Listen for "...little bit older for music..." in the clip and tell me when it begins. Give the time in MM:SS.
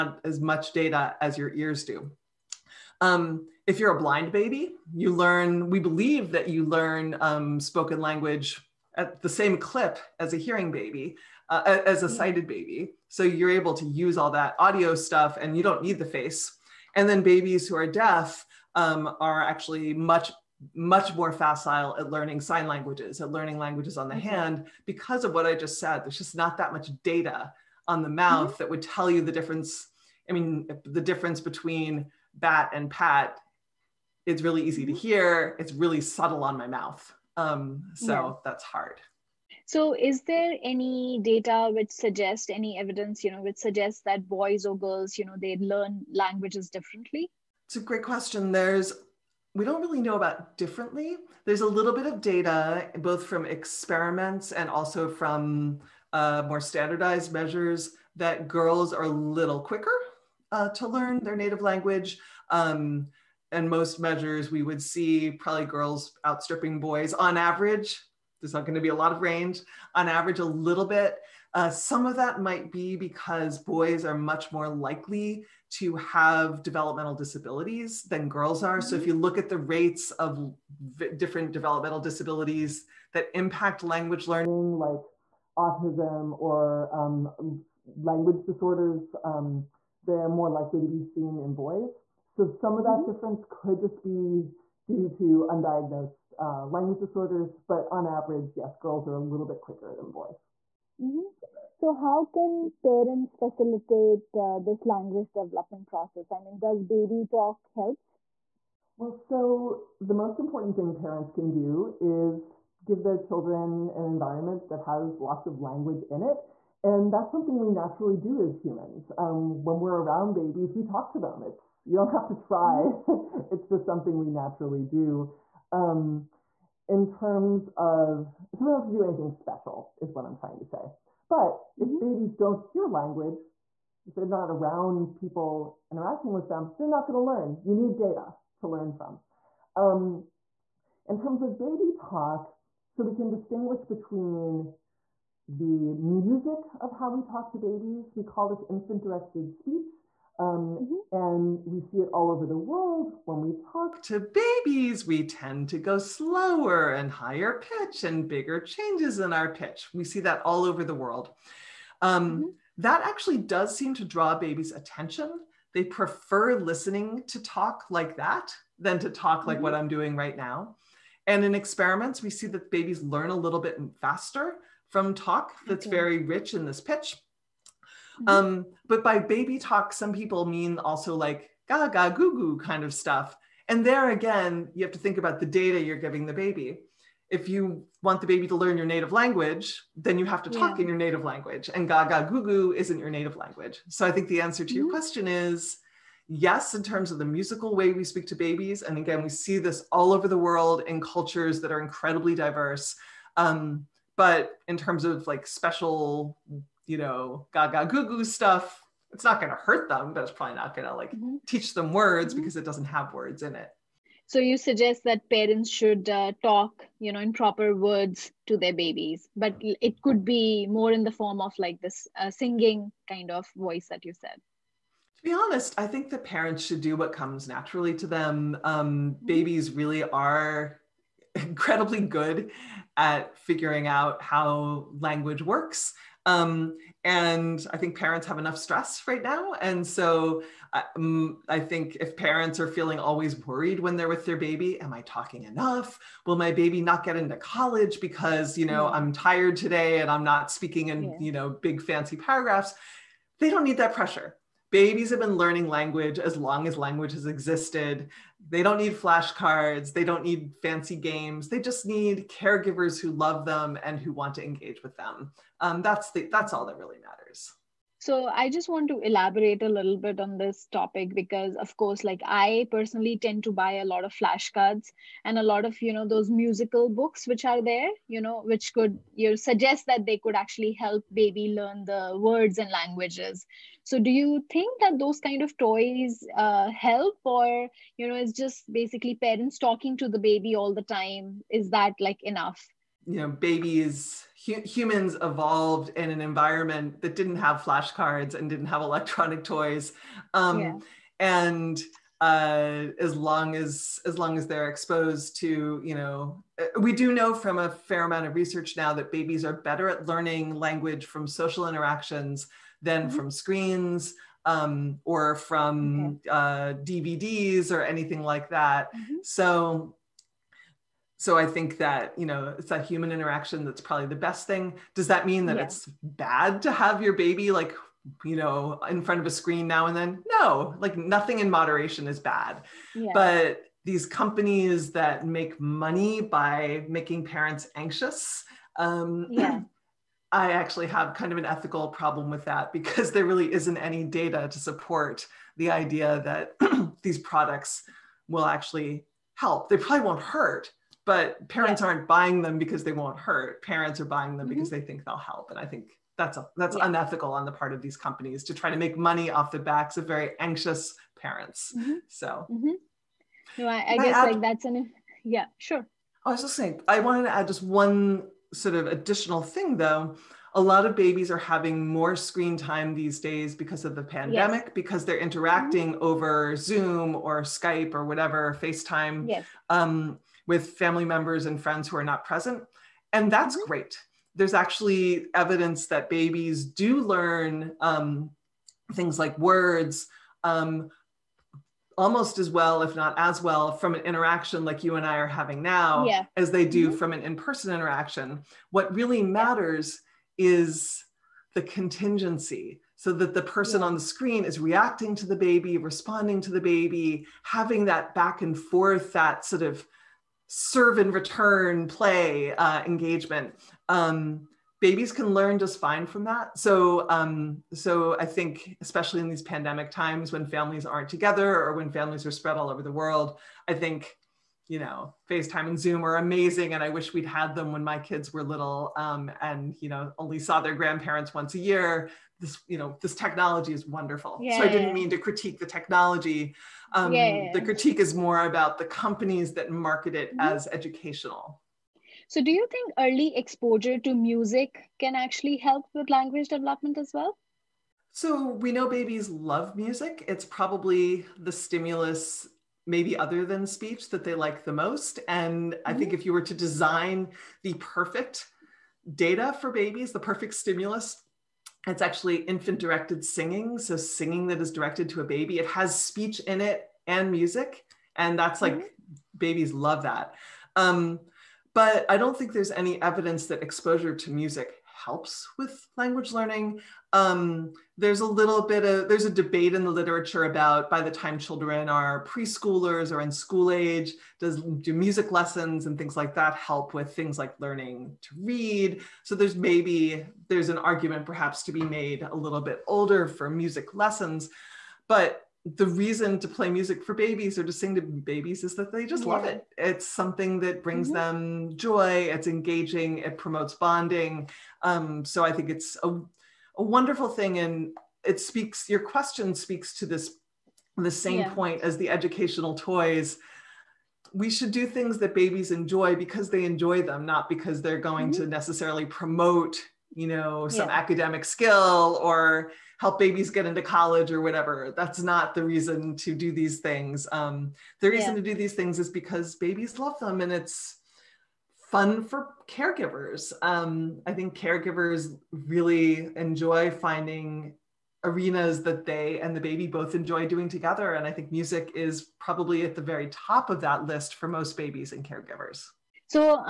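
08:12.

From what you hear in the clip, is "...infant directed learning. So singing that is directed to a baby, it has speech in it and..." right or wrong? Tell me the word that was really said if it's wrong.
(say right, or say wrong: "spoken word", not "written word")
wrong: "singing", not "learning".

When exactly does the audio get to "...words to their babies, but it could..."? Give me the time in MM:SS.
03:37.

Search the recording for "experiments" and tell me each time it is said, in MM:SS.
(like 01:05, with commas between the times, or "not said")
00:53, 02:51.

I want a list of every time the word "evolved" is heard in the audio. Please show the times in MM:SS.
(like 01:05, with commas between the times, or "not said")
04:55.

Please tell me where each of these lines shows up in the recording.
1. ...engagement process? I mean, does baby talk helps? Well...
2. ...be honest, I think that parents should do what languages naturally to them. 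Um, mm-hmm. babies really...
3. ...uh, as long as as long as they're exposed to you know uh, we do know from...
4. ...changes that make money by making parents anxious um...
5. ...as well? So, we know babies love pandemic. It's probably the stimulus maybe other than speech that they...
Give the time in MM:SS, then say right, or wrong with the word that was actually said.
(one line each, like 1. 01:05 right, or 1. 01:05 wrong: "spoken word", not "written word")
1. 01:45 wrong: "development", not "engagement"
2. 03:45 wrong: "comes", not "languages"
3. 05:02 right
4. 05:34 wrong: "companies", not "changes"
5. 07:26 wrong: "music", not "pandemic".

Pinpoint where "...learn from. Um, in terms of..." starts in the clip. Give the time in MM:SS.
02:18.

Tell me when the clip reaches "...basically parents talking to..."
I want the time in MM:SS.
04:48.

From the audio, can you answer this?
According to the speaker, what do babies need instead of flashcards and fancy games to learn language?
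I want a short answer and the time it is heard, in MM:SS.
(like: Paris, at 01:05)
caregivers who love them, at 04:22.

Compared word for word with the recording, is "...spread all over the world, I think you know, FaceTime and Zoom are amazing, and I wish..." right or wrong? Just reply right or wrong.
right.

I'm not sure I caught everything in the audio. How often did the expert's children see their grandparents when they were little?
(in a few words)
once a year.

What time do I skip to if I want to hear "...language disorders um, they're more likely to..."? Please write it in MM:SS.
01:28.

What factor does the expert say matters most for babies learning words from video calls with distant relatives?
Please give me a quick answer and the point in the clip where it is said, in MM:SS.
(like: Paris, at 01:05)
contingency, at 06:41.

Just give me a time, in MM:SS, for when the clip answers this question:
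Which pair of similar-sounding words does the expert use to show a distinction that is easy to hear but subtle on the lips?
00:32.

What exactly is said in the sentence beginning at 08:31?
point as the educational toys we should do things that babies enjoy because they enjoy them not because they're going mm-hmm.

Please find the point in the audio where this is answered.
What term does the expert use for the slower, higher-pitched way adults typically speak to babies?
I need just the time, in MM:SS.
02:28.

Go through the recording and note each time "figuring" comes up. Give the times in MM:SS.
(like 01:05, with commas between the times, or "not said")
03:53.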